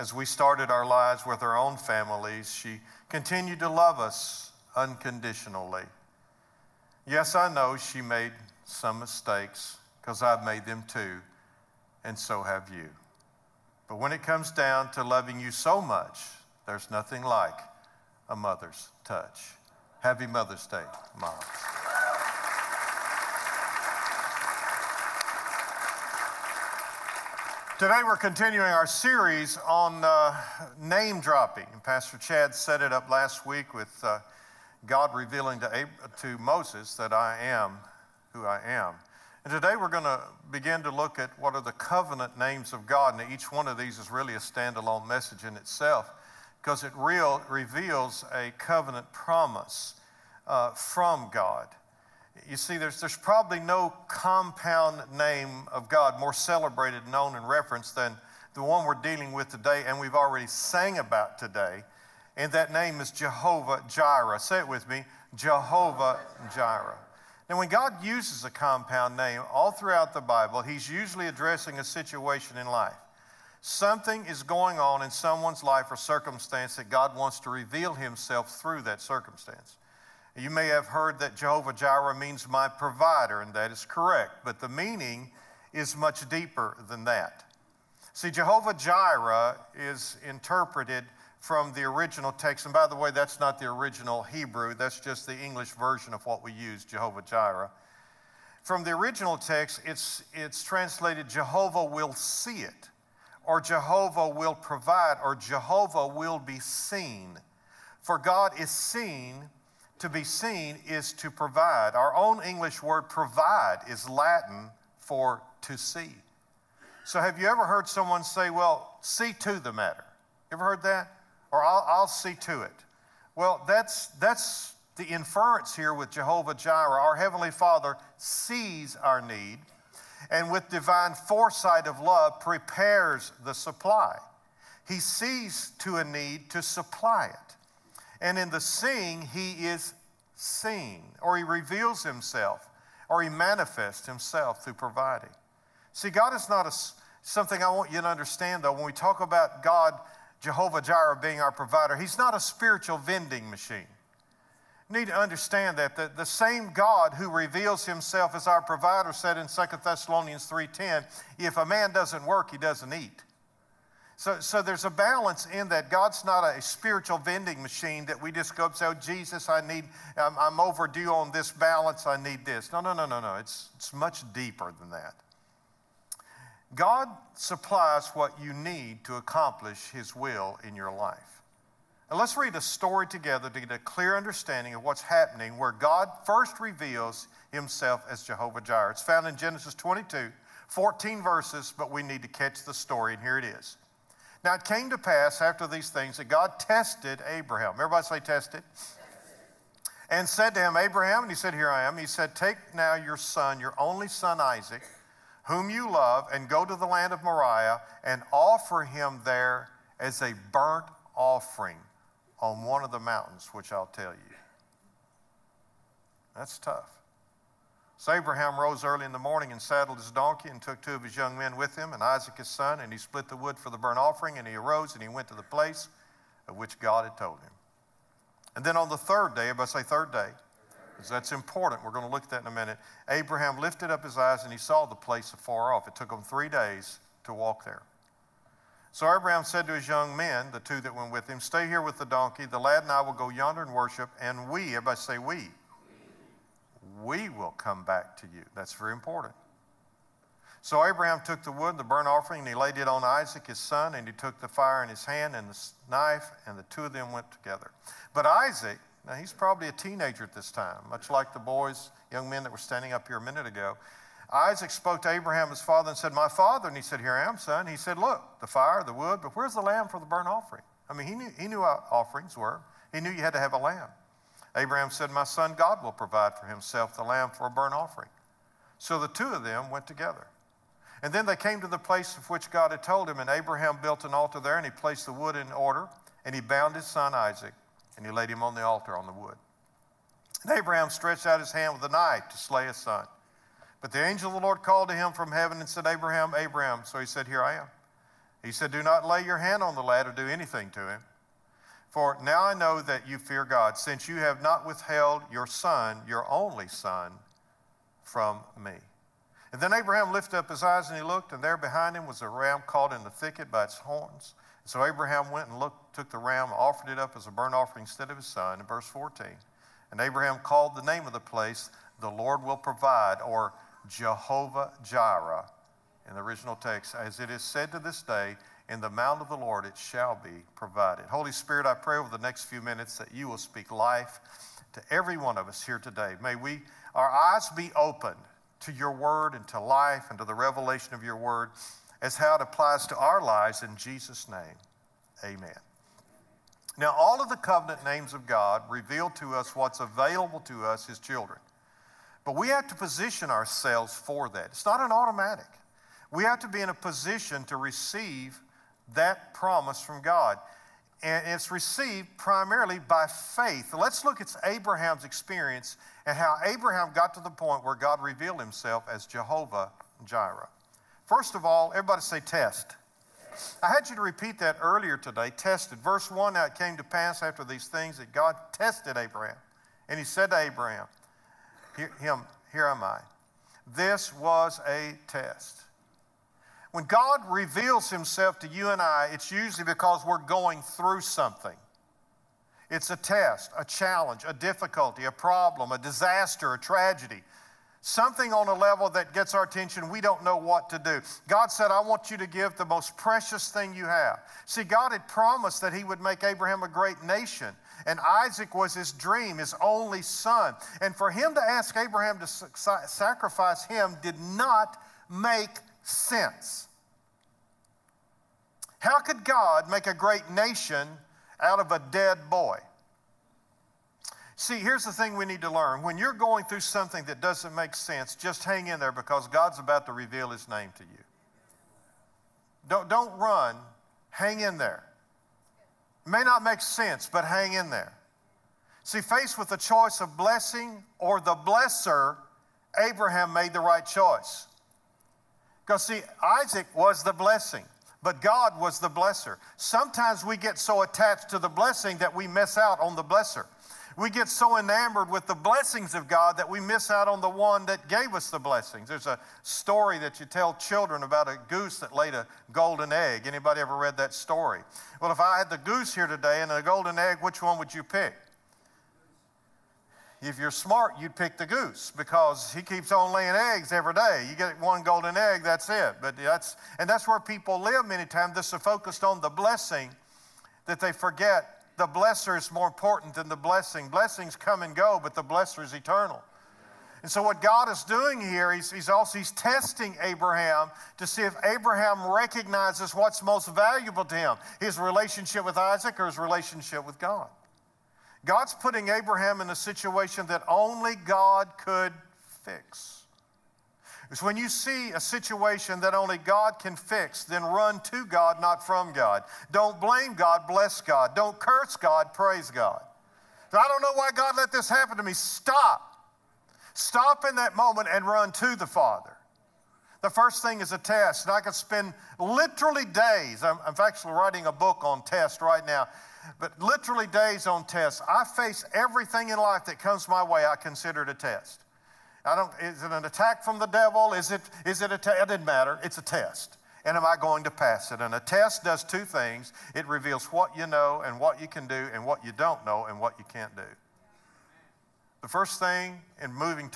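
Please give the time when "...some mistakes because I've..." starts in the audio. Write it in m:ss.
0:08.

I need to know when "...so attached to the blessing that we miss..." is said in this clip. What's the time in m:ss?
7:30.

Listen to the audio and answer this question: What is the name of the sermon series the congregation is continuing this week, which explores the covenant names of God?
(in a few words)
Name dropping.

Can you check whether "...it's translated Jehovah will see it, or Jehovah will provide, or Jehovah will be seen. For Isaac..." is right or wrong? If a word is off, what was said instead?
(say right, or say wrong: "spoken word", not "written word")
wrong: "God", not "Isaac".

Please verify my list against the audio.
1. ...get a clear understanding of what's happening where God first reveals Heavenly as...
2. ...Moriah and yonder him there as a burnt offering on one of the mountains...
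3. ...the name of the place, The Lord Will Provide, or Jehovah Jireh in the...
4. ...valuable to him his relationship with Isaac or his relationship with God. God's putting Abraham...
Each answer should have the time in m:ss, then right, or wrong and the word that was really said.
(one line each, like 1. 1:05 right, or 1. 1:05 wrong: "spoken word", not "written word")
1. 3:03 wrong: "Himself", not "Heavenly"
2. 3:27 wrong: "offer", not "yonder"
3. 5:20 right
4. 8:13 right.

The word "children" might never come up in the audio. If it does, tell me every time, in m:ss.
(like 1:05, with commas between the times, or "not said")
5:50, 7:40.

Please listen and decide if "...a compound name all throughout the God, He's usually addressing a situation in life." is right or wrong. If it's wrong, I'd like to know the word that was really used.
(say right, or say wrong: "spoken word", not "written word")
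wrong: "Bible", not "God".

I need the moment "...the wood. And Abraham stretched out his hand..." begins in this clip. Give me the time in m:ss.
4:49.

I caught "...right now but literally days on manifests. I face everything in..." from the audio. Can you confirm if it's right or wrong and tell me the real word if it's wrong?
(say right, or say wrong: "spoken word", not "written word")
wrong: "tests", not "manifests".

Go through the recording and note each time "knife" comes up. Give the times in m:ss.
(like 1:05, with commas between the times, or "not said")
4:15, 4:51.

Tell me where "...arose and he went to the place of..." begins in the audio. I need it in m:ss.
3:44.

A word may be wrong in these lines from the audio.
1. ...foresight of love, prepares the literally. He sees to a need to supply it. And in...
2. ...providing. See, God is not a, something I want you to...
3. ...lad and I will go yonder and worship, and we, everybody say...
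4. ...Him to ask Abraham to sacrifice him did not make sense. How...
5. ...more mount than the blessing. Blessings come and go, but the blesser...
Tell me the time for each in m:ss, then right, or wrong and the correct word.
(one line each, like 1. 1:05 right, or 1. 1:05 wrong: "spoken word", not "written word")
1. 2:11 wrong: "supply", not "literally"
2. 2:24 right
3. 4:02 right
4. 6:51 right
5. 8:02 wrong: "important", not "mount".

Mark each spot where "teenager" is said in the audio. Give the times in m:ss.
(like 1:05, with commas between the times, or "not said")
4:19.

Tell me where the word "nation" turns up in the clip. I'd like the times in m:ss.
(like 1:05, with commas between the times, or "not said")
6:47, 7:00.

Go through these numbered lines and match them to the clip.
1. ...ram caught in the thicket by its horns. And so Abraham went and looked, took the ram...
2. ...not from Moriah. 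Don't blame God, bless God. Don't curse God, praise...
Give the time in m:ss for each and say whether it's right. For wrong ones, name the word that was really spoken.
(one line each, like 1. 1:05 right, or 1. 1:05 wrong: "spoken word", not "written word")
1. 5:12 right
2. 8:28 wrong: "God", not "Moriah".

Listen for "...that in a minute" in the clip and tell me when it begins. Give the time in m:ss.
3:52.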